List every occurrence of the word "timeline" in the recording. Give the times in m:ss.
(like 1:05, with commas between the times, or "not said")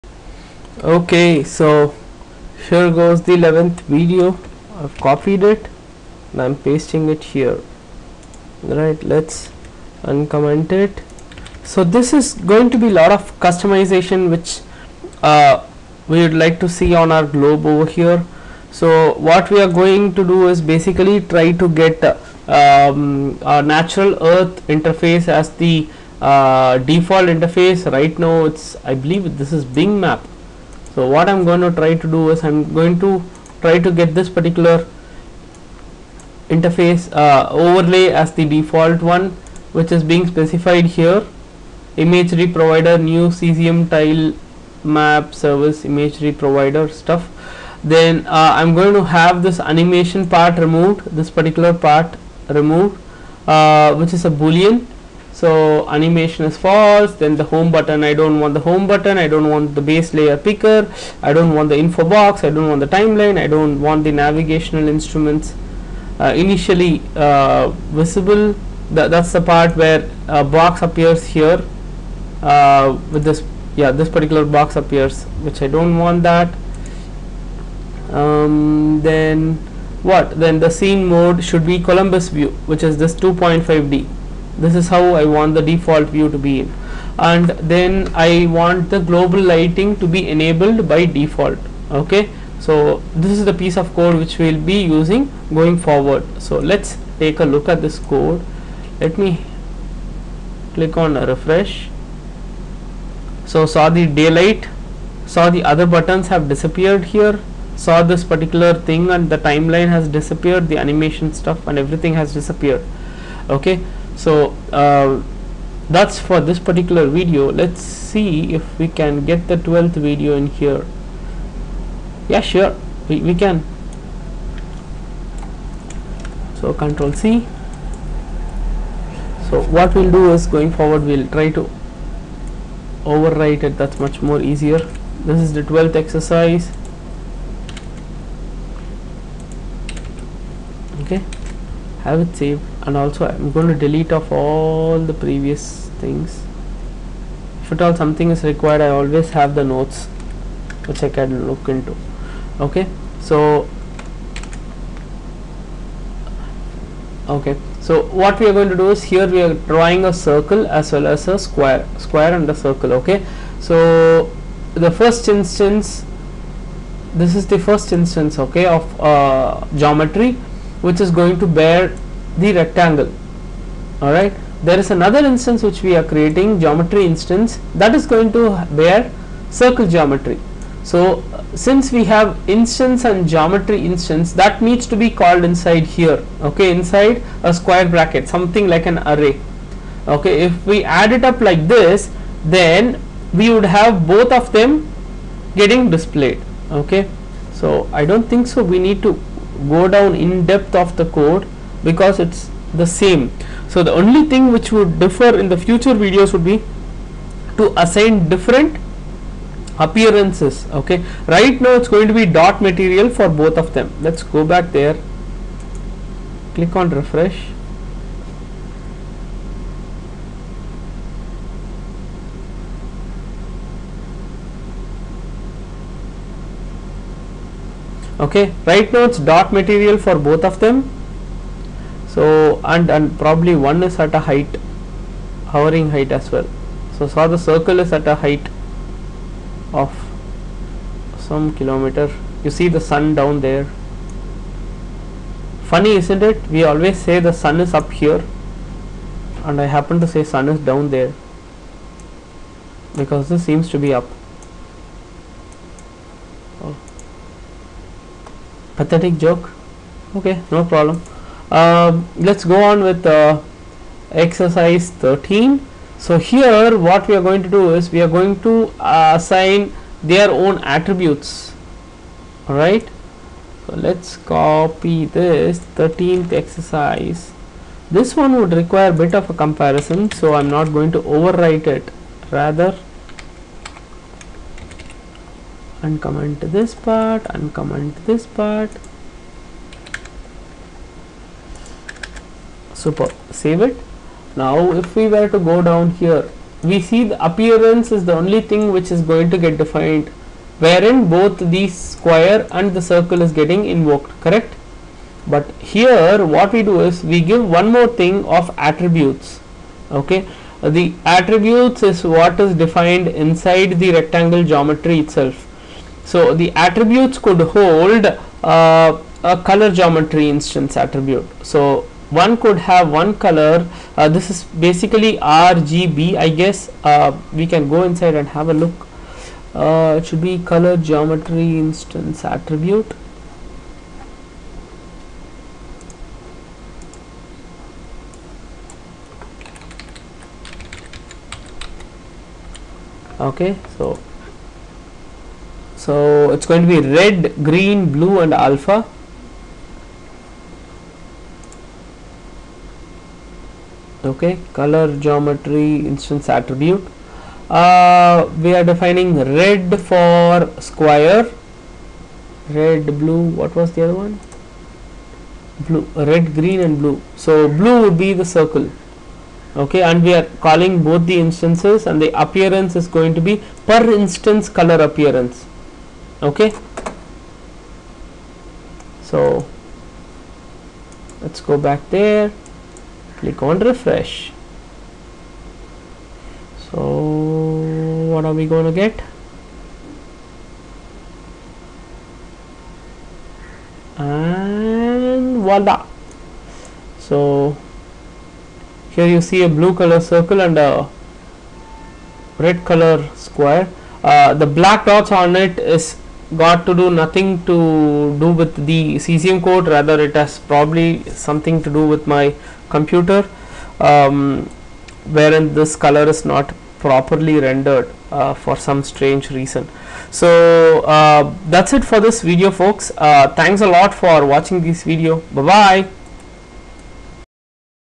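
1:02, 1:49.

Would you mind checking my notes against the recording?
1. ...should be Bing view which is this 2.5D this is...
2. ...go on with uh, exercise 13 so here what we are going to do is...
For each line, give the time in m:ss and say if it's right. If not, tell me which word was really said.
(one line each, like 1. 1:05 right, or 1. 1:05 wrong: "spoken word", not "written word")
1. 1:21 wrong: "Columbus", not "Bing"
2. 4:22 right.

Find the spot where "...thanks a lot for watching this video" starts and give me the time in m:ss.
7:03.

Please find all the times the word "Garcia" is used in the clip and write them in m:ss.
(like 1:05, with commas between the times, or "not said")
not said.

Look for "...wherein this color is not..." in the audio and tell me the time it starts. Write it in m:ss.
6:55.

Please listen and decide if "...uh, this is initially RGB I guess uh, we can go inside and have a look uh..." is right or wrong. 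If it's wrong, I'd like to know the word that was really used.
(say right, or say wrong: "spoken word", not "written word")
wrong: "basically", not "initially".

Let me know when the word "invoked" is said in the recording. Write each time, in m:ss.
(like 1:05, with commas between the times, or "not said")
5:03.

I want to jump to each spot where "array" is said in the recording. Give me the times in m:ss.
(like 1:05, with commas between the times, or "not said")
3:09.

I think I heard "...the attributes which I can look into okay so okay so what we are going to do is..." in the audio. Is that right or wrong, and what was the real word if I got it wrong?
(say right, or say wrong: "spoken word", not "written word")
wrong: "notes", not "attributes".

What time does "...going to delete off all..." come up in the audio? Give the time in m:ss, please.
2:23.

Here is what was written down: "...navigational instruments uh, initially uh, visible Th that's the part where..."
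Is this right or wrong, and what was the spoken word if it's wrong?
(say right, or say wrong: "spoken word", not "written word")
right.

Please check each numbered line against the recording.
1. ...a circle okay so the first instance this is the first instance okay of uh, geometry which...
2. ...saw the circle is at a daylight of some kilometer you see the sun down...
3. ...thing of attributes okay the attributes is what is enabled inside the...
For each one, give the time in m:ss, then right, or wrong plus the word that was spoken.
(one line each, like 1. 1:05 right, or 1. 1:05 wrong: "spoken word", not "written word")
1. 2:42 right
2. 3:57 wrong: "height", not "daylight"
3. 5:08 wrong: "defined", not "enabled".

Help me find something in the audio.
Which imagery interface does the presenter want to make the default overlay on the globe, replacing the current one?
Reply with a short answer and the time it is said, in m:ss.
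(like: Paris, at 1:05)
Natural Earth, at 0:23.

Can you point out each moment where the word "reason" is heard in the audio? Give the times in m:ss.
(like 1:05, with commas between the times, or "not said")
6:59.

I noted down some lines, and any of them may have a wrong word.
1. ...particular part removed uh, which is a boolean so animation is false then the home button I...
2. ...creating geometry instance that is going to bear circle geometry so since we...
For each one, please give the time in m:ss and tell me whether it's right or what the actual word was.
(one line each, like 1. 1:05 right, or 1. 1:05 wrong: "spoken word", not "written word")
1. 0:51 right
2. 2:56 right.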